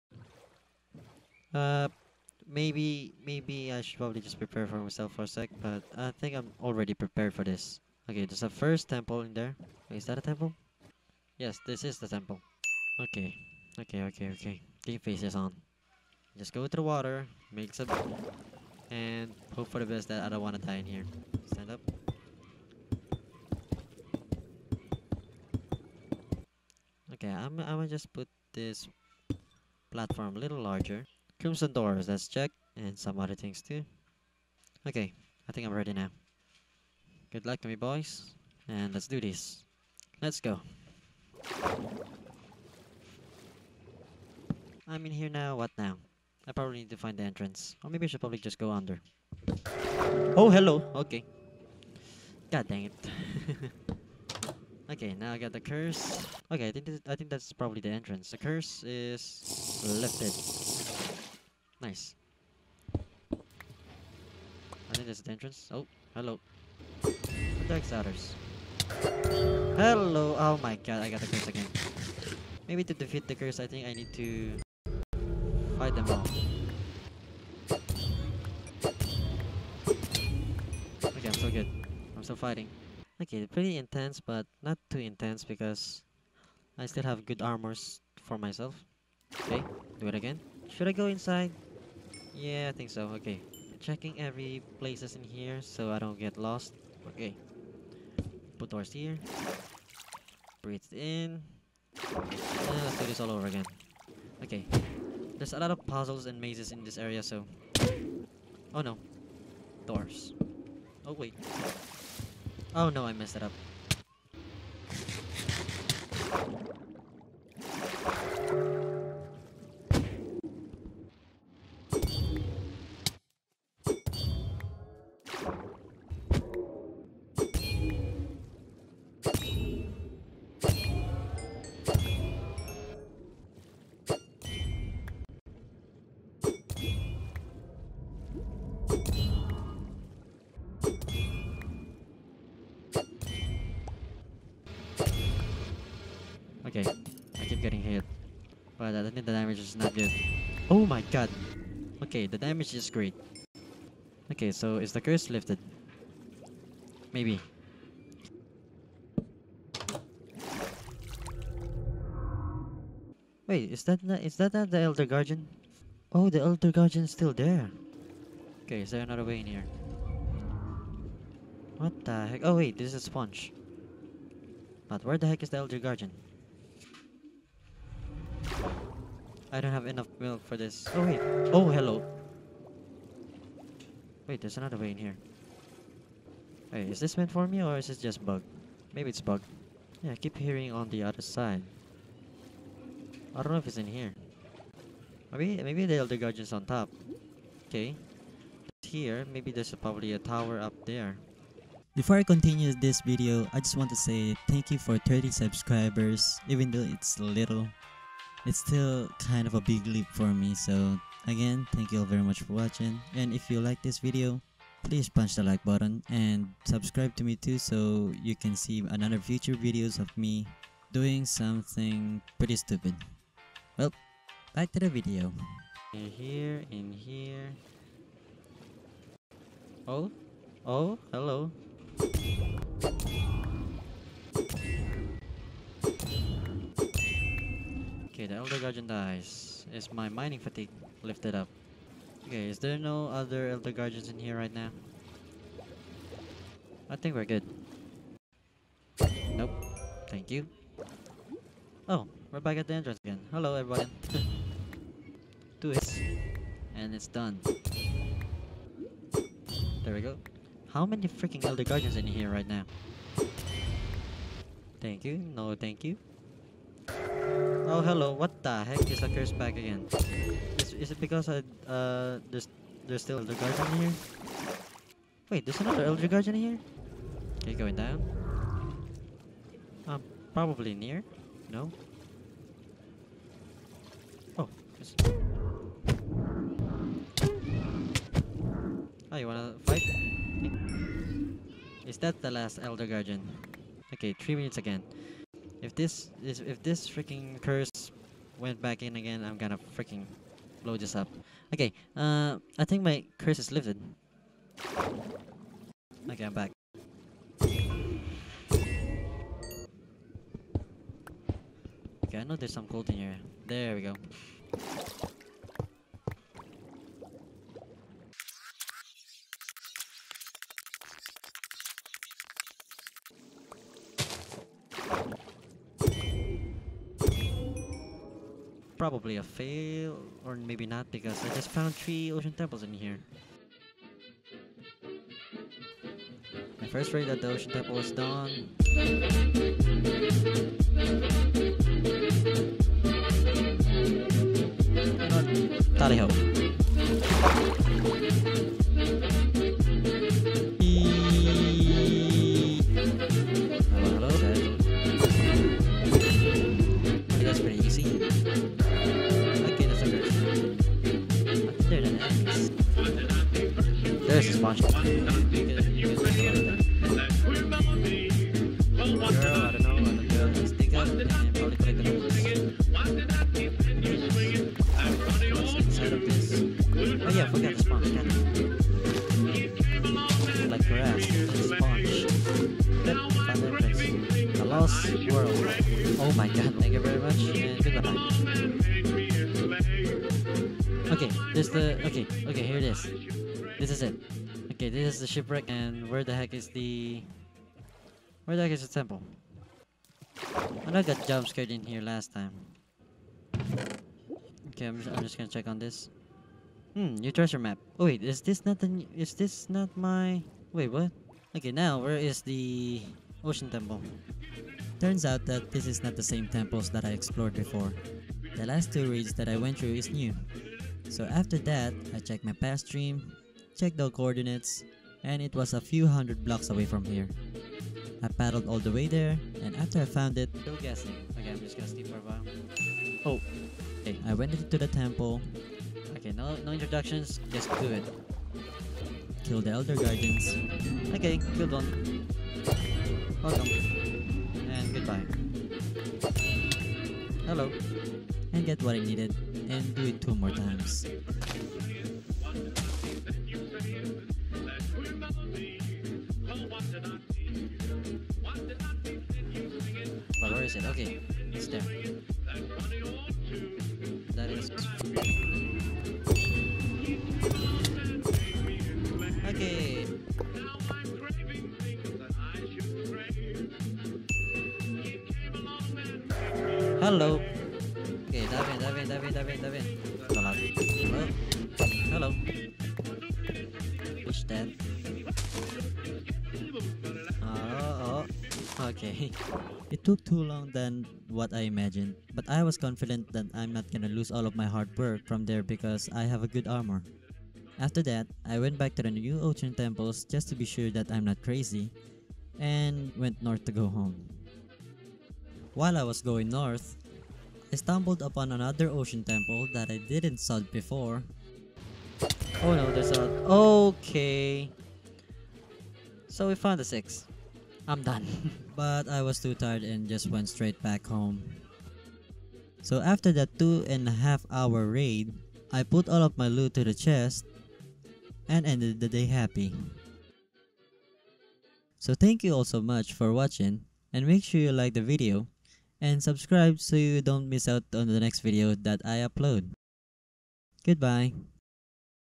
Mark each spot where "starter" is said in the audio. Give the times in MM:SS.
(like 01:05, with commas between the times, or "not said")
not said.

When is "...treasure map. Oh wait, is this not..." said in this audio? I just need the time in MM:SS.
06:47.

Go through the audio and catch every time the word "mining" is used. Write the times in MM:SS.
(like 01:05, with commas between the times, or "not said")
04:00.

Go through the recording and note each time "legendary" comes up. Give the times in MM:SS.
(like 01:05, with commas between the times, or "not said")
not said.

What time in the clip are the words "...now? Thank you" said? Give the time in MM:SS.
04:22.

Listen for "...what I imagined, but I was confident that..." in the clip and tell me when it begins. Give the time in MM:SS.
08:11.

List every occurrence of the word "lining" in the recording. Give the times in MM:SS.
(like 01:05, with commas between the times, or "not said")
not said.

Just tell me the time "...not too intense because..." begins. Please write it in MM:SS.
01:24.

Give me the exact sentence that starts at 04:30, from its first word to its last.
Is, is it because I, uh, there's, there's still Elder Guardian here?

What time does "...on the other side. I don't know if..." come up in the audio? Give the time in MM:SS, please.
03:10.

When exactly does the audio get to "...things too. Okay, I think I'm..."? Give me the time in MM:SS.
00:33.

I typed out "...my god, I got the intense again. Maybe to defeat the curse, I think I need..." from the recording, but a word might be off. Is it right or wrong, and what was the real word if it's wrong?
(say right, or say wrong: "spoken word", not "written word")
wrong: "curse", not "intense".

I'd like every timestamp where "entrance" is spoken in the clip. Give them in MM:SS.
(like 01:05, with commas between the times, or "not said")
00:47, 00:57, 01:05, 04:12.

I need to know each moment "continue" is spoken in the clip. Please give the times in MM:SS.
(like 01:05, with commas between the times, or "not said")
03:22.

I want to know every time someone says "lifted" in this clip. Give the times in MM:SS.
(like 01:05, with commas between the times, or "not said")
00:59, 02:35, 04:01, 05:03.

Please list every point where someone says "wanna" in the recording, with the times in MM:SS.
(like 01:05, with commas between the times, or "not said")
04:49.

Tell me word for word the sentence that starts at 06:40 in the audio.
I know I got jump scared in here last time.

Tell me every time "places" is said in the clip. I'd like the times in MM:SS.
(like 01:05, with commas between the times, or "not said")
01:34.